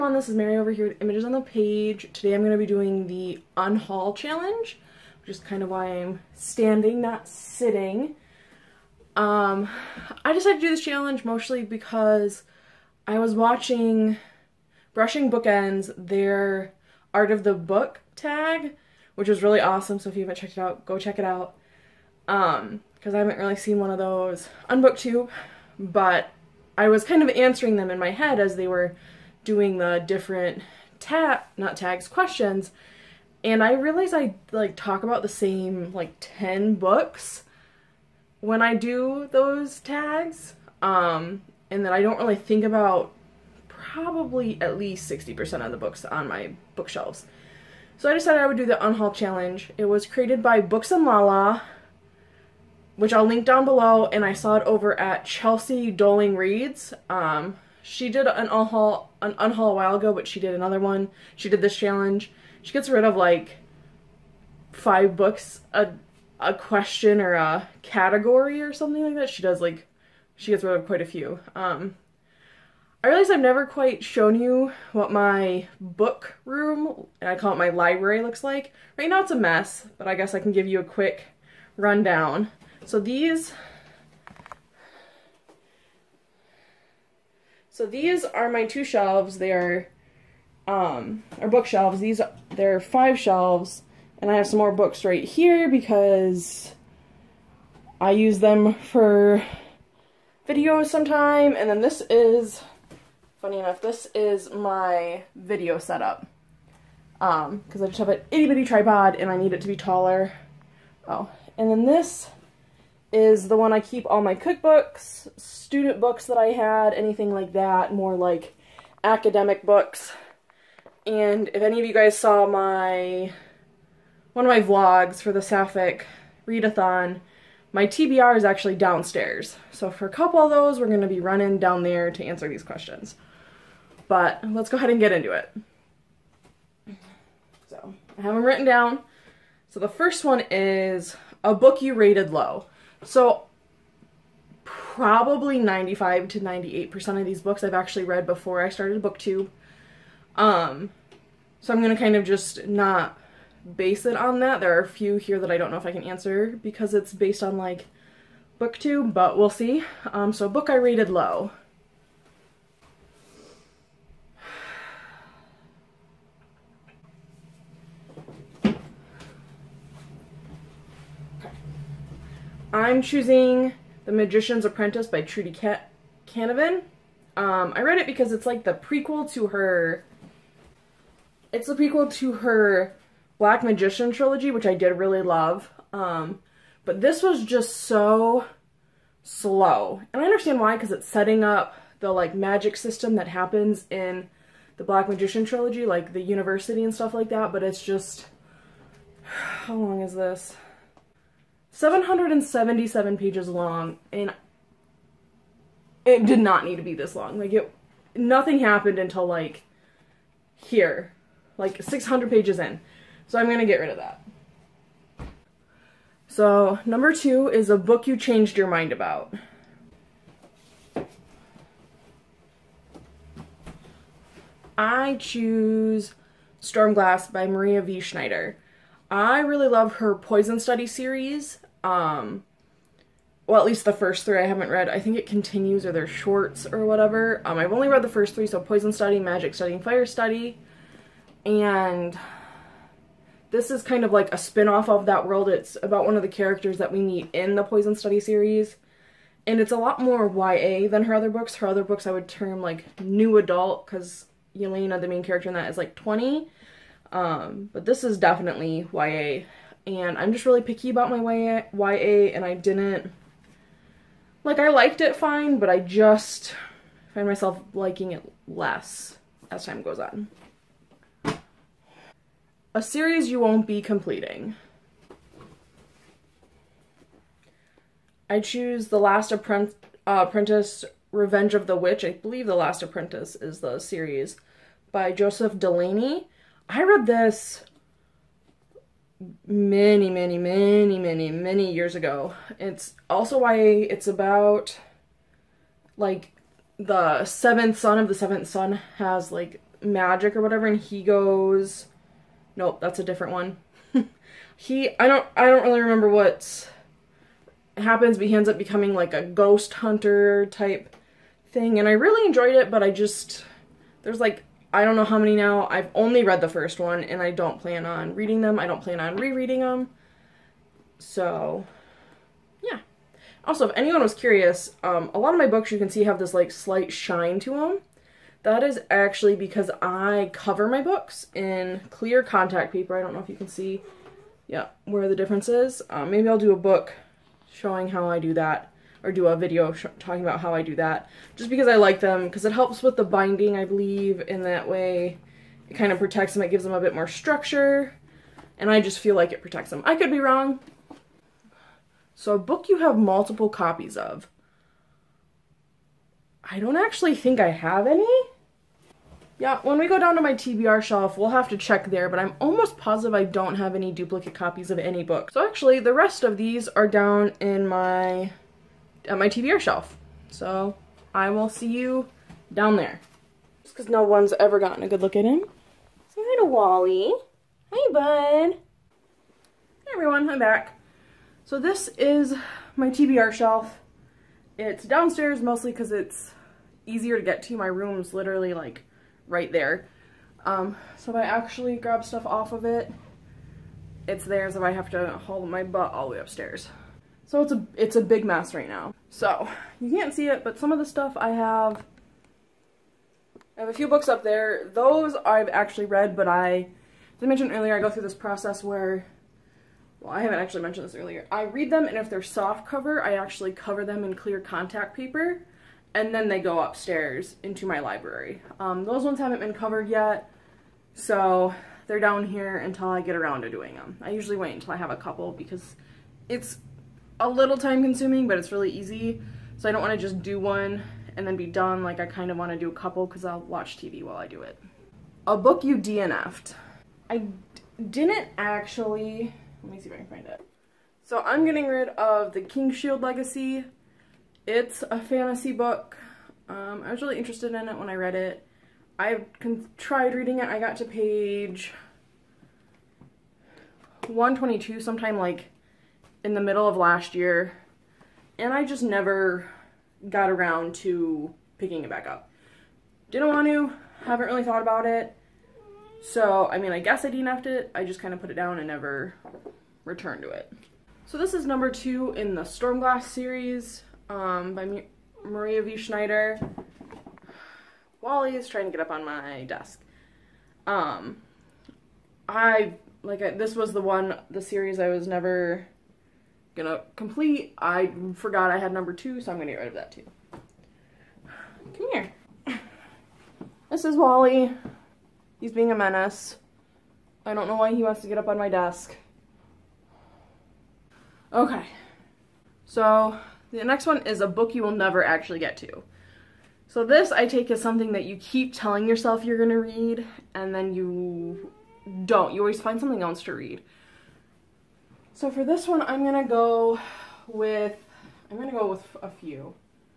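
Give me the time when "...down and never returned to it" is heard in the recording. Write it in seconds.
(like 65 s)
468 s.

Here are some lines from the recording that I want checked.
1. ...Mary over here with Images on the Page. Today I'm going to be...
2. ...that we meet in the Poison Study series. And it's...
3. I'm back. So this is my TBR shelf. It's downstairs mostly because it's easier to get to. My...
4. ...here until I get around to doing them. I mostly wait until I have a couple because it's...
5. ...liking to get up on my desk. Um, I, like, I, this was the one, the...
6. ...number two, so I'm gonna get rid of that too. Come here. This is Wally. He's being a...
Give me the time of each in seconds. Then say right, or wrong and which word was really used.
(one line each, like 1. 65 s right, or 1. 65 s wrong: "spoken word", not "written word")
1. 0 s right
2. 246 s right
3. 380 s right
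4. 422 s wrong: "usually", not "mostly"
5. 478 s wrong: "trying", not "liking"
6. 488 s right.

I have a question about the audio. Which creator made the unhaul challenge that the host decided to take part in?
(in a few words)
Books and Lala.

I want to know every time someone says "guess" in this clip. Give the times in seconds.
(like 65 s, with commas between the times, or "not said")
80 s, 466 s.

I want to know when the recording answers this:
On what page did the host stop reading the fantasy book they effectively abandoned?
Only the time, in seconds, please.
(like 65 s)
450 s.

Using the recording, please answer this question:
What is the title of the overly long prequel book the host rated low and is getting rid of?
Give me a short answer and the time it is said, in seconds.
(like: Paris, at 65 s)
The Magician's Apprentice, at 174 s.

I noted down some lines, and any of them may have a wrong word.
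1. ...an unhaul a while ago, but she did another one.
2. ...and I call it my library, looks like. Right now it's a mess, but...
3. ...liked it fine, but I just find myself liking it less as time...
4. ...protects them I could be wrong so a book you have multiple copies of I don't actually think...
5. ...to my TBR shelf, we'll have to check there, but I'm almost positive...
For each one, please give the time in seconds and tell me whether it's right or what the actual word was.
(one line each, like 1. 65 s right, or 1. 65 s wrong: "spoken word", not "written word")
1. 59 s right
2. 77 s right
3. 264 s right
4. 349 s right
5. 360 s right.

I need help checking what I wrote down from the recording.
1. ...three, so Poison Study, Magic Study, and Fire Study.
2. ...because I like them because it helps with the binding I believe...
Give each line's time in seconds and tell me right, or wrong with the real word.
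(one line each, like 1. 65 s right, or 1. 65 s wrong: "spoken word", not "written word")
1. 238 s right
2. 341 s right.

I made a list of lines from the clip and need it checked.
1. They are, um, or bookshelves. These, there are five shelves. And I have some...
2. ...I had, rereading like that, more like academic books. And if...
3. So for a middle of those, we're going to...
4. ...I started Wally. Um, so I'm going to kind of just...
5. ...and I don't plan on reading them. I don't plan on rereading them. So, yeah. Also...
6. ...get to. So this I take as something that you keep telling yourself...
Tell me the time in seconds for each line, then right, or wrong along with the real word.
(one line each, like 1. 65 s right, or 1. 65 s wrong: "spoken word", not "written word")
1. 89 s right
2. 116 s wrong: "anything", not "rereading"
3. 129 s wrong: "couple", not "middle"
4. 148 s wrong: "BookTube", not "Wally"
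5. 317 s right
6. 505 s right.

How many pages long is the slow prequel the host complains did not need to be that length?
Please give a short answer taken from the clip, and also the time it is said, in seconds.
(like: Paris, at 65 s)
777, at 201 s.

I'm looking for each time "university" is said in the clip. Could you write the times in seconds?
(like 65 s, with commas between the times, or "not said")
196 s.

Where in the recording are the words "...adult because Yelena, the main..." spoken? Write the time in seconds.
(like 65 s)
253 s.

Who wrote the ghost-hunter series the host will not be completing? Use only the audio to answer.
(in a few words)
Joseph Delaney.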